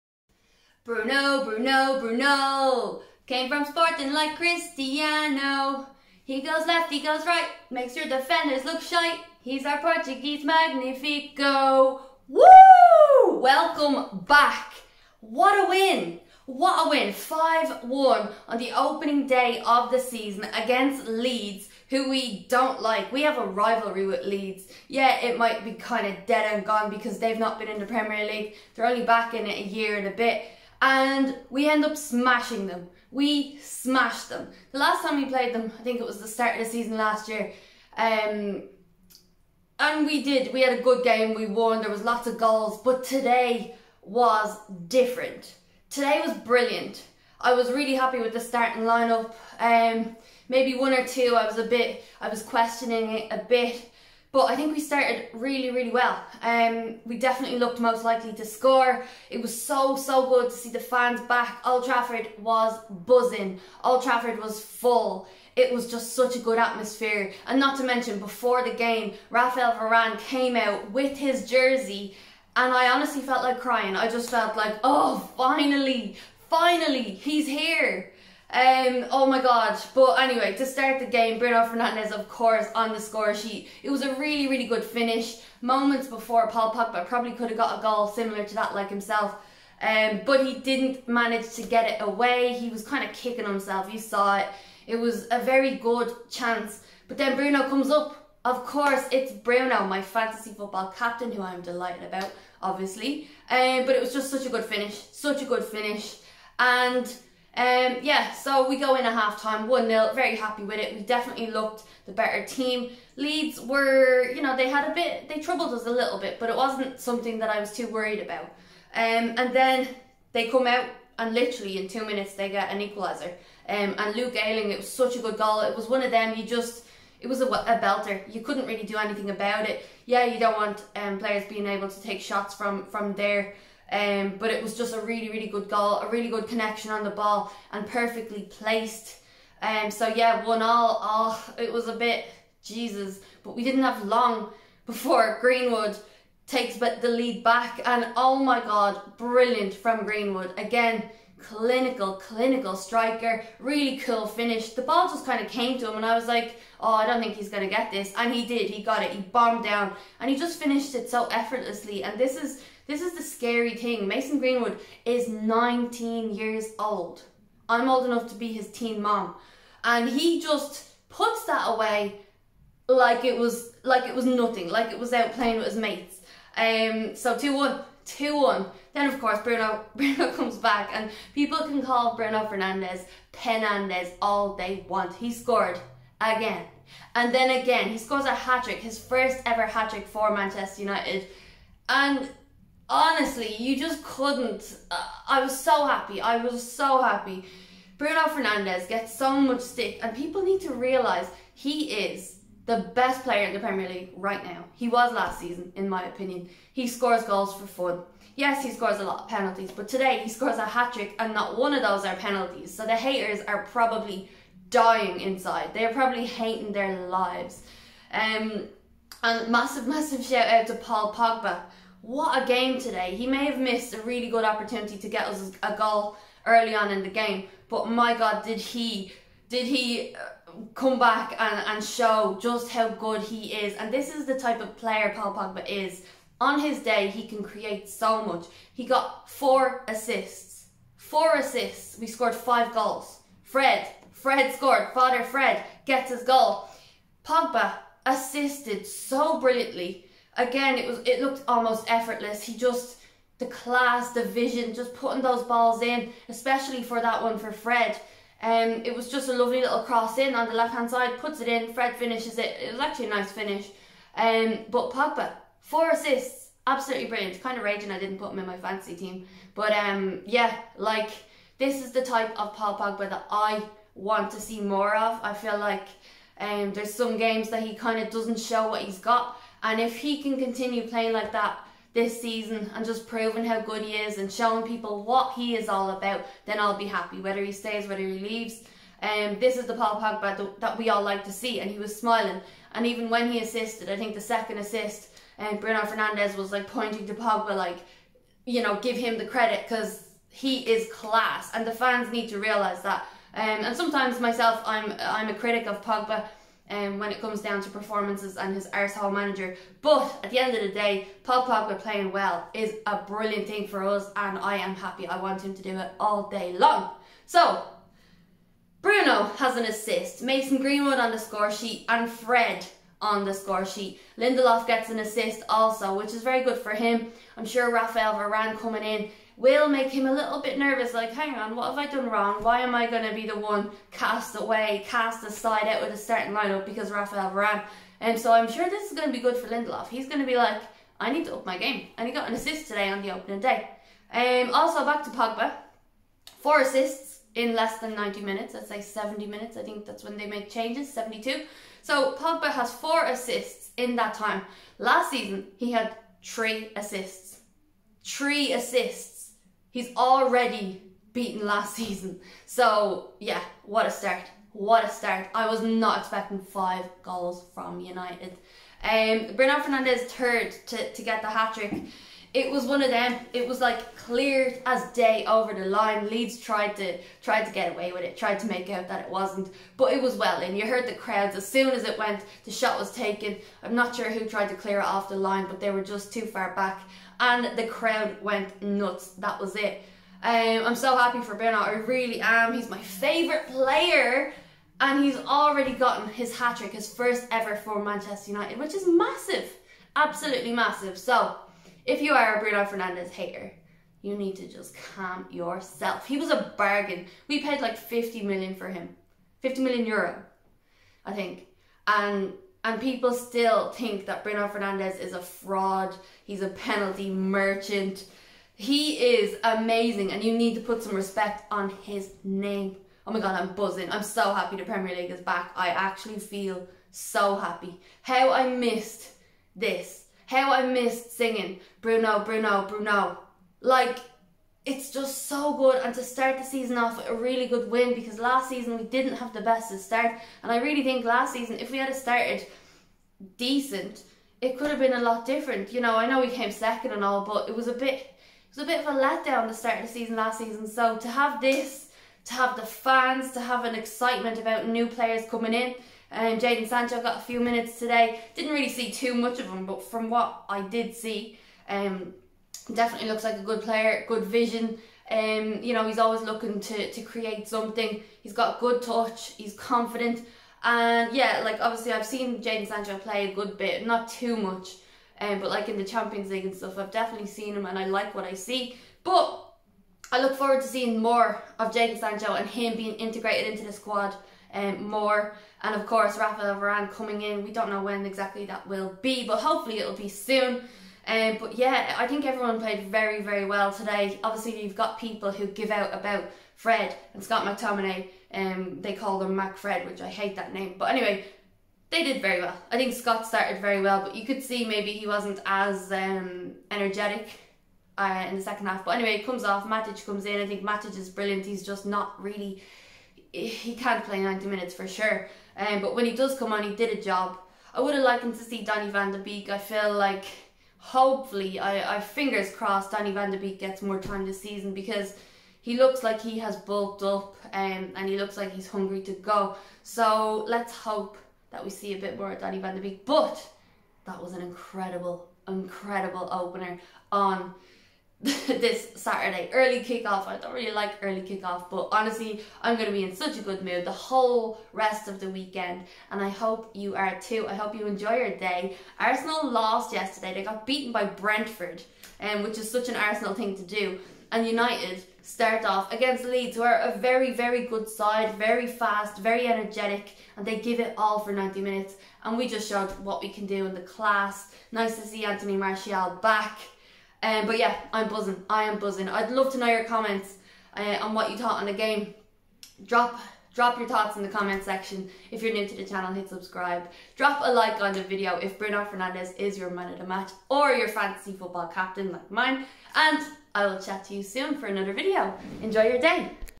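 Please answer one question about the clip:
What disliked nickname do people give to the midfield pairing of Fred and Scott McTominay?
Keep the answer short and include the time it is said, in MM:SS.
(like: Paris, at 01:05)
Mac Fred, at 08:19.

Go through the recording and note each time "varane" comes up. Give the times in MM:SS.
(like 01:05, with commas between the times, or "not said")
01:09, 05:28, 05:37, 08:06.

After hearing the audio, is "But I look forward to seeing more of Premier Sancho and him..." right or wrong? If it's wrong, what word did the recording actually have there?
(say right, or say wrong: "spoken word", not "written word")
wrong: "Jadon", not "Premier".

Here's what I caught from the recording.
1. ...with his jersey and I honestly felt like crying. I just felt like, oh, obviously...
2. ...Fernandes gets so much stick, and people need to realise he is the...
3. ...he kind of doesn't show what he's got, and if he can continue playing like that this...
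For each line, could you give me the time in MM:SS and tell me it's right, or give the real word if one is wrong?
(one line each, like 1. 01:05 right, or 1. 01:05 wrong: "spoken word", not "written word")
1. 01:10 wrong: "finally", not "obviously"
2. 03:18 right
3. 04:37 right.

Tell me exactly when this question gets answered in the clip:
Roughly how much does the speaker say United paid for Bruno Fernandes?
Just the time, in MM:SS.
06:49.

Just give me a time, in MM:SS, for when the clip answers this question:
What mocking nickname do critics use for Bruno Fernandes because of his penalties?
03:03.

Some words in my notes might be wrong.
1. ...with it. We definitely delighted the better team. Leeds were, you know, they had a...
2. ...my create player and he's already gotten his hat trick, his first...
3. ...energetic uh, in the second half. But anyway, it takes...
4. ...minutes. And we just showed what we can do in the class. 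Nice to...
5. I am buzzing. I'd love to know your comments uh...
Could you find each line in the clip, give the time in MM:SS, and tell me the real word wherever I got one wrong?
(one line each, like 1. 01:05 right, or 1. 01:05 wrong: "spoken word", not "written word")
1. 01:50 wrong: "looked", not "delighted"
2. 06:32 wrong: "favourite", not "create"
3. 08:26 wrong: "comes", not "takes"
4. 09:21 right
5. 09:28 right.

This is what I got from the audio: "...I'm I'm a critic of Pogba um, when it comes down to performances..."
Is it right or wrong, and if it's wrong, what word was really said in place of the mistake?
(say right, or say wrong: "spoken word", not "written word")
right.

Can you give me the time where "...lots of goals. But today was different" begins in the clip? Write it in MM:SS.
00:42.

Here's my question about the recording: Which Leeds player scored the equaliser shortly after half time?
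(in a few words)
Luke Ayling.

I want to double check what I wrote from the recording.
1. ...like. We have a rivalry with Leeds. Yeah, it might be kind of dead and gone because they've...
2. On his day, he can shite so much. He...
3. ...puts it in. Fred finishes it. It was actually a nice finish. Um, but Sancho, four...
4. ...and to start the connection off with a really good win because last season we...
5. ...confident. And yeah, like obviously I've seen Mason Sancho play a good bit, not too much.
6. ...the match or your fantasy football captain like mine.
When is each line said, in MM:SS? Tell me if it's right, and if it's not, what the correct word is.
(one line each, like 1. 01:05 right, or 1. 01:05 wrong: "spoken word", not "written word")
1. 00:22 right
2. 03:56 wrong: "create", not "shite"
3. 04:21 wrong: "Pogba", not "Sancho"
4. 07:15 wrong: "season", not "connection"
5. 07:49 wrong: "Jadon", not "Mason"
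6. 09:39 right.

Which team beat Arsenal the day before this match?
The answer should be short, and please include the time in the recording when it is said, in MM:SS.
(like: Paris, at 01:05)
Brentford, at 09:11.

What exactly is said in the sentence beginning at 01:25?
Moments before Paul Pogba probably could have got a goal similar to that like himself.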